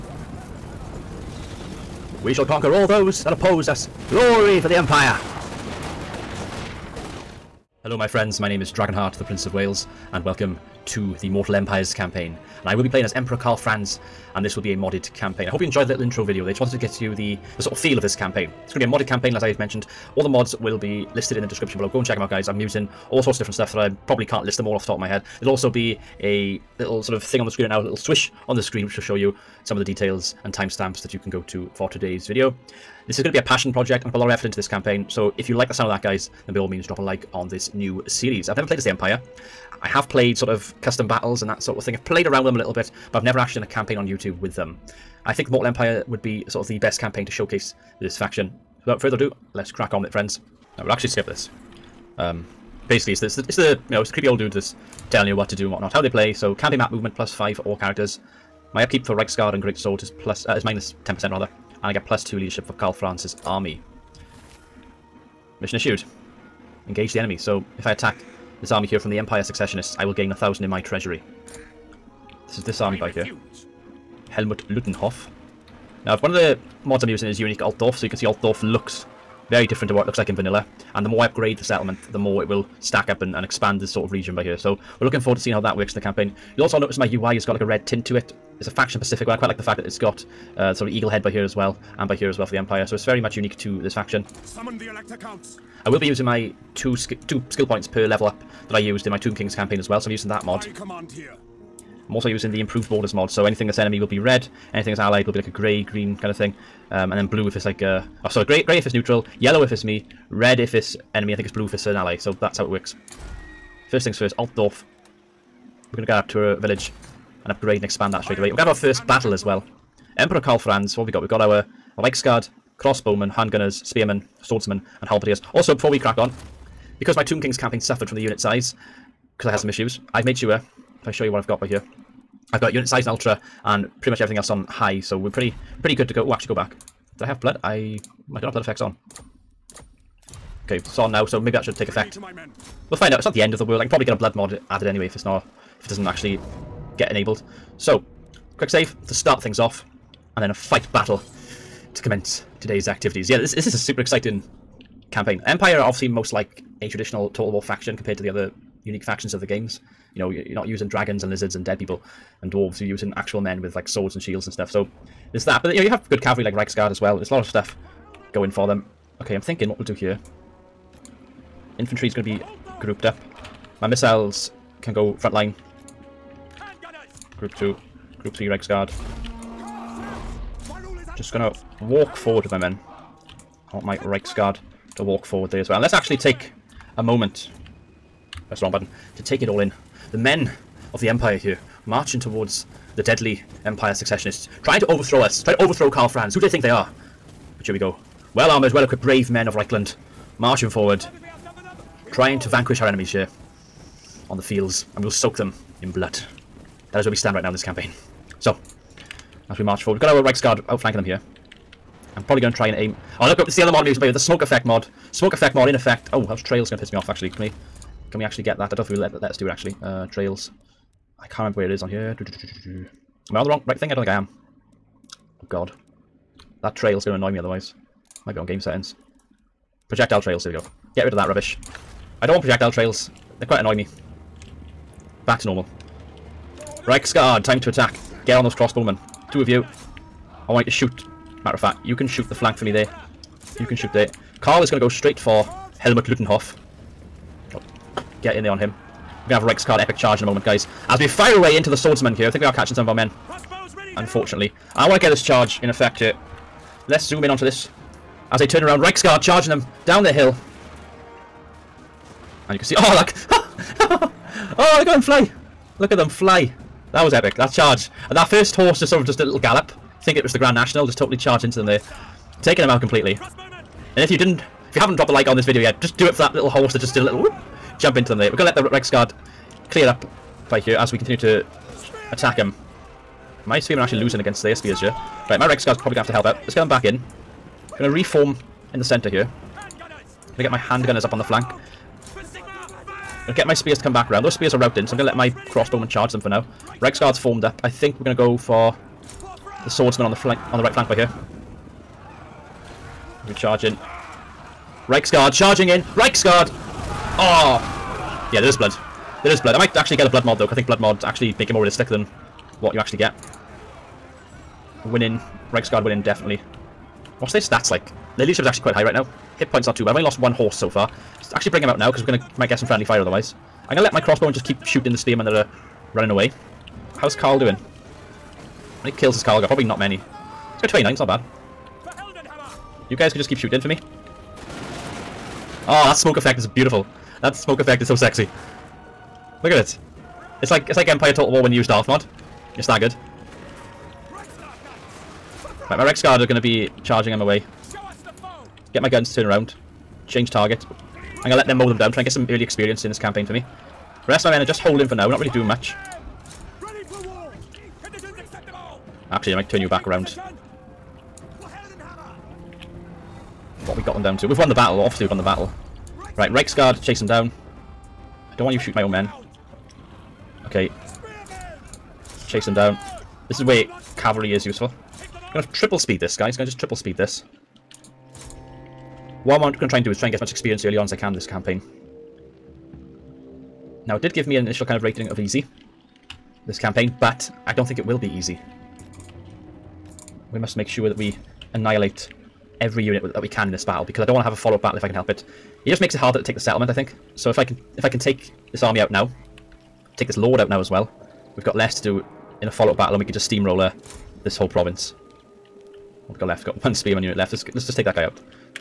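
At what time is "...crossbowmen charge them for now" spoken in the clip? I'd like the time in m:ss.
4:55.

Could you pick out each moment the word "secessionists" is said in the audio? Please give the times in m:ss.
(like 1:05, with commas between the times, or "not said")
1:09, 3:13.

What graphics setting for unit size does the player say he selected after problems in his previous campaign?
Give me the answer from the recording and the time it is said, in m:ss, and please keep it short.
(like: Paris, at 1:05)
Ultra, at 2:13.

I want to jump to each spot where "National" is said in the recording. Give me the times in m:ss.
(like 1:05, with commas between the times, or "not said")
4:30.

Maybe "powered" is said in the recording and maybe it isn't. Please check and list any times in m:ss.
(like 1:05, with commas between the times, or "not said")
not said.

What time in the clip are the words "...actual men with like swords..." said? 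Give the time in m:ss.
2:43.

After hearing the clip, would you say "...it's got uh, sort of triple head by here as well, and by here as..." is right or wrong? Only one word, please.
wrong.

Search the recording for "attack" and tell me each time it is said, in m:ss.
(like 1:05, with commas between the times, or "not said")
1:07, 3:57, 4:42.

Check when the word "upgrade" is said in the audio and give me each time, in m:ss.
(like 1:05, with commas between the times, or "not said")
1:21, 1:57.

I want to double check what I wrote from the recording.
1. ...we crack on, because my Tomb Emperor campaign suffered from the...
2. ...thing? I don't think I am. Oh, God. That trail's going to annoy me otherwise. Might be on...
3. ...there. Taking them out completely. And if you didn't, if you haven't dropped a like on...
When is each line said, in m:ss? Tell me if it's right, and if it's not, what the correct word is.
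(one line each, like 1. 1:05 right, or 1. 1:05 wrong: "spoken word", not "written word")
1. 2:05 wrong: "Kings", not "Emperor"
2. 3:43 right
3. 4:31 right.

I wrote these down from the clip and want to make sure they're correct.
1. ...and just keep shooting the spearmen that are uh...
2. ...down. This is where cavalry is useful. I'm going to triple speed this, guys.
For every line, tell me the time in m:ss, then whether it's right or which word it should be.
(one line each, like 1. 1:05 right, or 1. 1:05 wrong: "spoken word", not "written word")
1. 5:24 right
2. 6:12 right.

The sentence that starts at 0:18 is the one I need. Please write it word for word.
It's going to be a modded campaign, as I have mentioned.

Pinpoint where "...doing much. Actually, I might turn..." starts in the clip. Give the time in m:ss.
5:55.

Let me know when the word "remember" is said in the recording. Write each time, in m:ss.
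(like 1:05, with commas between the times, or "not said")
3:41.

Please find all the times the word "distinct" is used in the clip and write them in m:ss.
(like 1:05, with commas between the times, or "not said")
not said.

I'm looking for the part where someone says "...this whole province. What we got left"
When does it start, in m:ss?
6:44.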